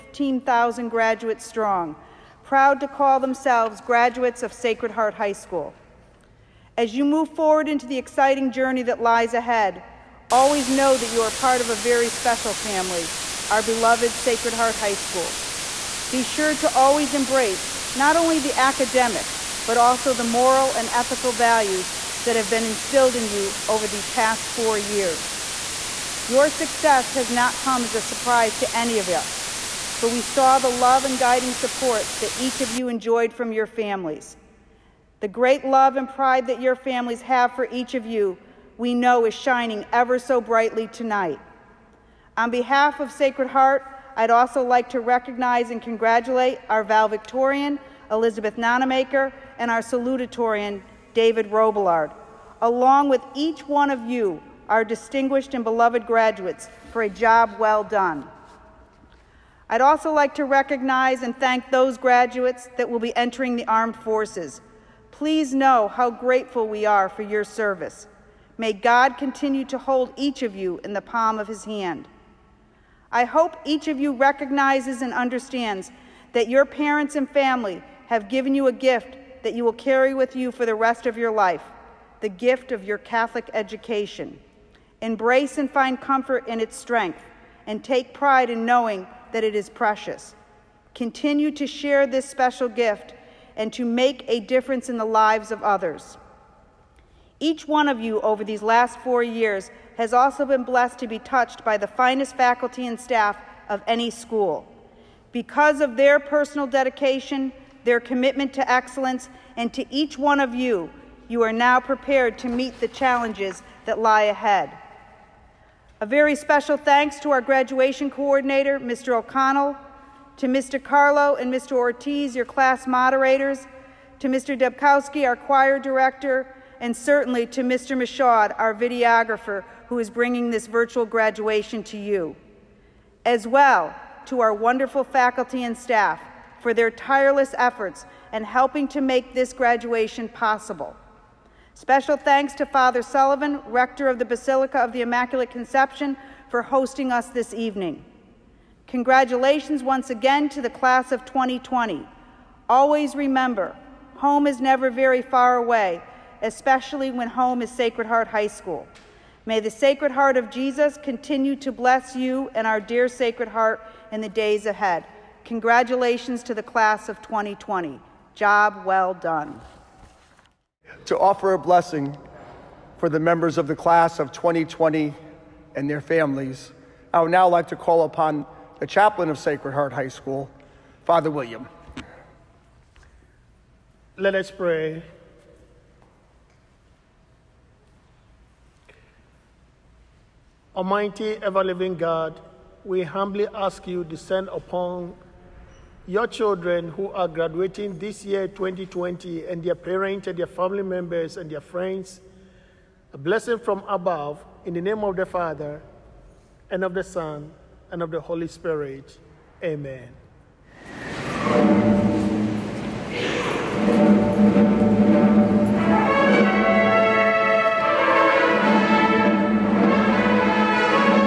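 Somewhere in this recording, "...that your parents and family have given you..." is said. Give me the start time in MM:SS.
01:16.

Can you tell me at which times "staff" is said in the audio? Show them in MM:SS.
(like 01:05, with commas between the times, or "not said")
01:42, 02:15.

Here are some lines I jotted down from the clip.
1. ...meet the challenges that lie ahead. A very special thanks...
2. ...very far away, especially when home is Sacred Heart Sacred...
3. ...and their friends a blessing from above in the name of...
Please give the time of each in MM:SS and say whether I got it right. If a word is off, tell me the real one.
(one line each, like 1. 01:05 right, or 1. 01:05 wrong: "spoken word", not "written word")
1. 01:52 right
2. 02:34 wrong: "High", not "Sacred"
3. 03:21 right.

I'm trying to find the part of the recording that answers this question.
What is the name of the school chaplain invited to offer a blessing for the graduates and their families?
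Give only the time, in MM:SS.
03:01.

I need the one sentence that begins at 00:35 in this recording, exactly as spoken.
The great love and pride that your families have for each of you, we know is shining ever so brightly tonight.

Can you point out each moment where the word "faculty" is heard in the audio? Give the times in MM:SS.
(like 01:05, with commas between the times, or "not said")
01:42, 02:15.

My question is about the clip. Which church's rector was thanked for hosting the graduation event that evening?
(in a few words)
Basilica of the Immaculate Conception.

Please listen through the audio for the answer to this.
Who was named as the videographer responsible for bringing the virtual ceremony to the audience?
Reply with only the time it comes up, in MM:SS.
02:07.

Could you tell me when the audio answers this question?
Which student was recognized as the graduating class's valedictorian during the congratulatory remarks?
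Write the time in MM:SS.
00:48.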